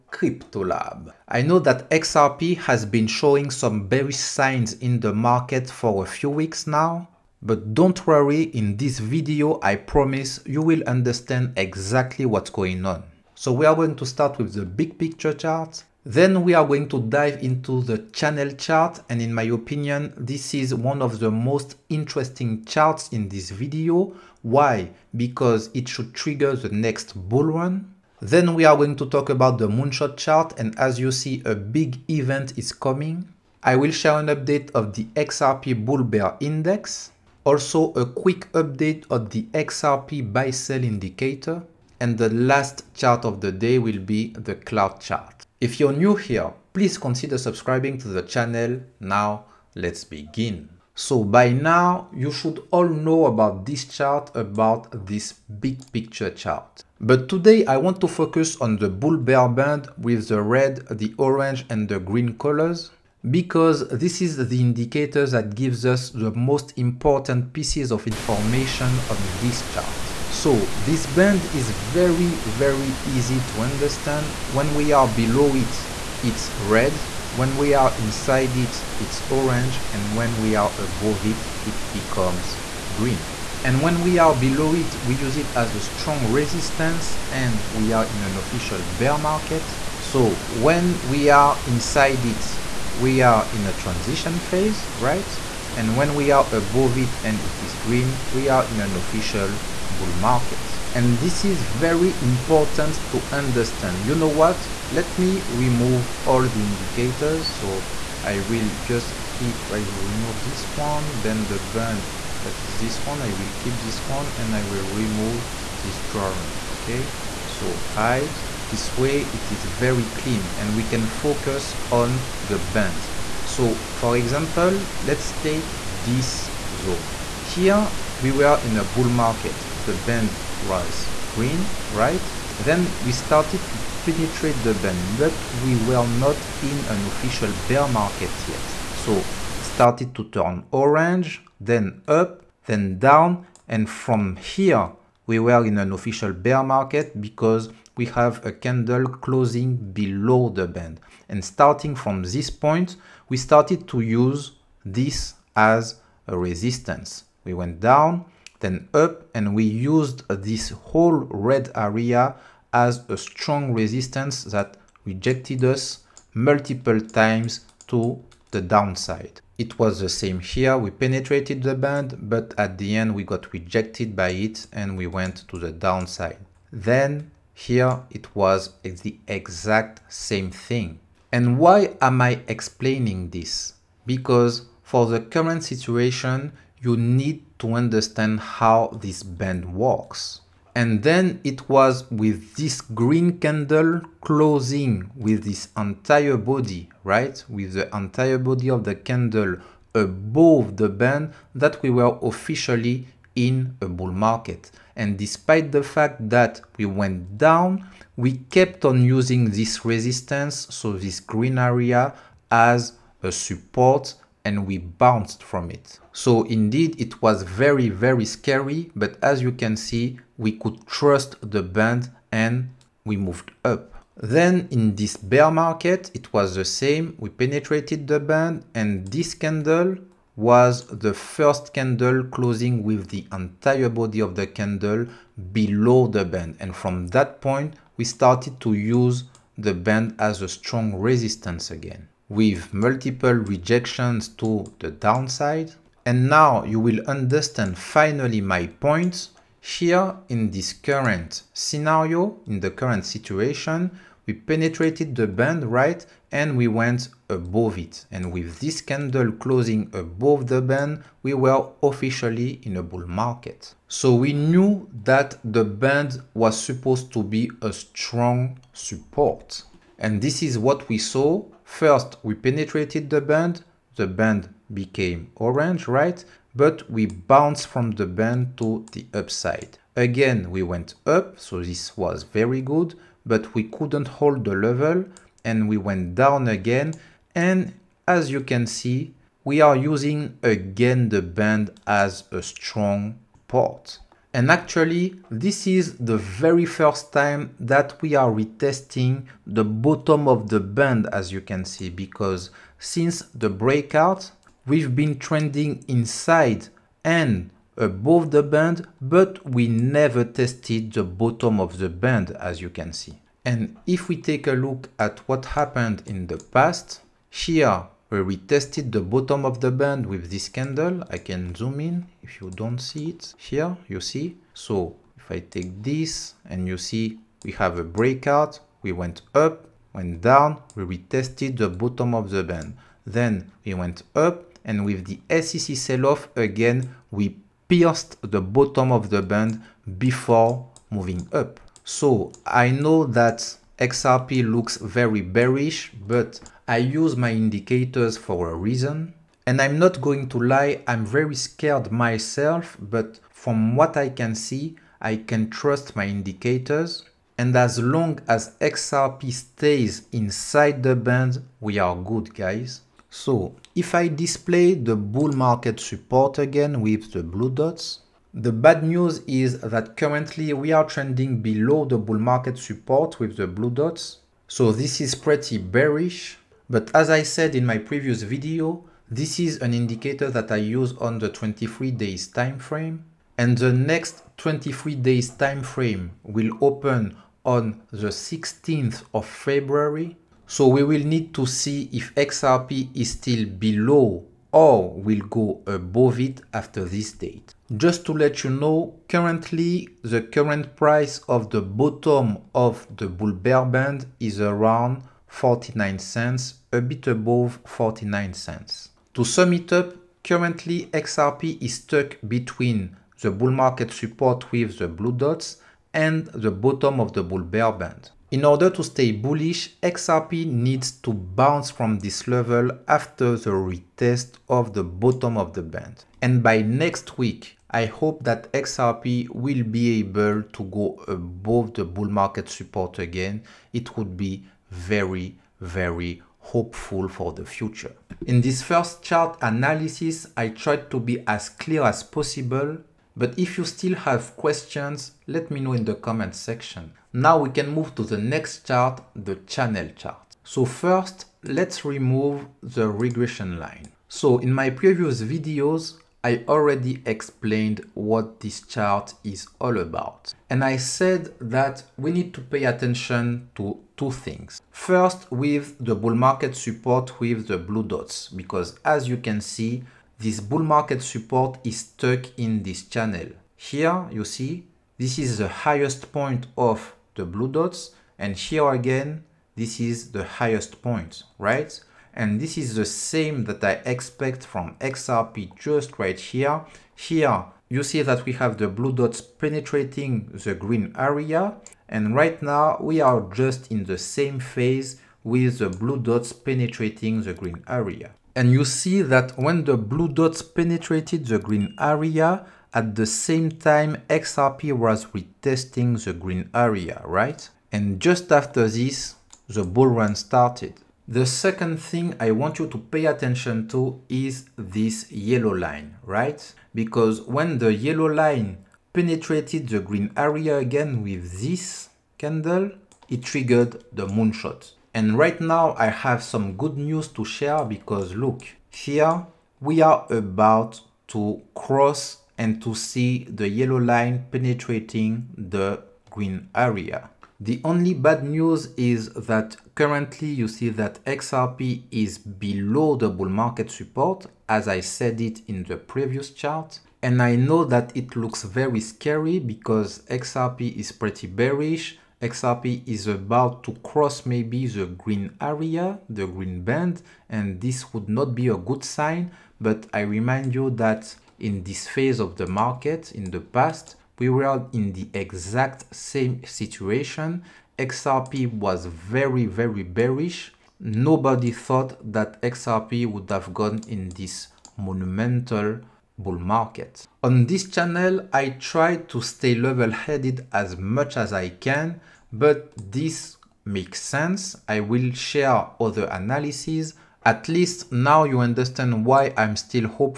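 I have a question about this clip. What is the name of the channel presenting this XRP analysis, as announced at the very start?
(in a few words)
Crypto Lab.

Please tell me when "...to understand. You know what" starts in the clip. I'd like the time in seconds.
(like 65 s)
103 s.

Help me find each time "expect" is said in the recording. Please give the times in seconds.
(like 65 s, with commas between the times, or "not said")
483 s.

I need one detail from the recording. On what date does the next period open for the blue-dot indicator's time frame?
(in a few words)
16th of February.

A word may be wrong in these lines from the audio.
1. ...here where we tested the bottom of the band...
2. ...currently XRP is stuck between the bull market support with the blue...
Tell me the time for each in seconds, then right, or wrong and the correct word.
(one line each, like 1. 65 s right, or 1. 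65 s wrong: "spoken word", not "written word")
1. 317 s right
2. 410 s right.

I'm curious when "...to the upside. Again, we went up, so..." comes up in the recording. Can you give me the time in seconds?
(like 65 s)
278 s.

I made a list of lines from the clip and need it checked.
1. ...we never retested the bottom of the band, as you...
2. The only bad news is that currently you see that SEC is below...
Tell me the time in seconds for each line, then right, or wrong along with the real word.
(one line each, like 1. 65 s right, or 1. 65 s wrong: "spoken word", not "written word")
1. 309 s wrong: "tested", not "retested"
2. 537 s wrong: "XRP", not "SEC".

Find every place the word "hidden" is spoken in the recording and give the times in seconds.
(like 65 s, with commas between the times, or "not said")
not said.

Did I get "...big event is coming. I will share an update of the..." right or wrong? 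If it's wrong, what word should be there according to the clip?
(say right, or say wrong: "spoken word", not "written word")
right.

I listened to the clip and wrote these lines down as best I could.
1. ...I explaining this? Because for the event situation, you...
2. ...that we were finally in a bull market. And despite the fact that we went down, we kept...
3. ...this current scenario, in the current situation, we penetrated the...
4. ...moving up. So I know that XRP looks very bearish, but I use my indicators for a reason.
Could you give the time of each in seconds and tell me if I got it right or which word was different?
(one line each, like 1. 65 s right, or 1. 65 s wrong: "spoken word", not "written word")
1. 182 s wrong: "current", not "event"
2. 201 s wrong: "officially", not "finally"
3. 250 s right
4. 340 s right.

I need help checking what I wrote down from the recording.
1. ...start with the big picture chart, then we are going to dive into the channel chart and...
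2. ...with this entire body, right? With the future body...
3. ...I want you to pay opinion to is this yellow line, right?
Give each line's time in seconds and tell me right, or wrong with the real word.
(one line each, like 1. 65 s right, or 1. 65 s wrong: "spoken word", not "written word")
1. 14 s right
2. 195 s wrong: "entire", not "future"
3. 512 s wrong: "attention", not "opinion".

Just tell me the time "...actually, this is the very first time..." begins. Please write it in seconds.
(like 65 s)
294 s.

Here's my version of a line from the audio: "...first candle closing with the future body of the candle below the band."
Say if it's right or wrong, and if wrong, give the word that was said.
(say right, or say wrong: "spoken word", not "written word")
wrong: "entire", not "future".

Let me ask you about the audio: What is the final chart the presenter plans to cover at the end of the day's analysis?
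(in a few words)
cloud chart.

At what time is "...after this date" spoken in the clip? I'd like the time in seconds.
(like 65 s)
396 s.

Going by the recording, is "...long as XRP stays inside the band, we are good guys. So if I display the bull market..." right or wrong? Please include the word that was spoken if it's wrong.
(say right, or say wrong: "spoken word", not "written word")
right.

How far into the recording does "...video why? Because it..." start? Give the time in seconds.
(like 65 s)
23 s.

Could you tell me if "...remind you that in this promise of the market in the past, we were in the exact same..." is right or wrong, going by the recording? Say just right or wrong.
wrong.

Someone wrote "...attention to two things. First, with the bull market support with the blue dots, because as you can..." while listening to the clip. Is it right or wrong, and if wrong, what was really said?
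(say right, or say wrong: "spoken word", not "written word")
right.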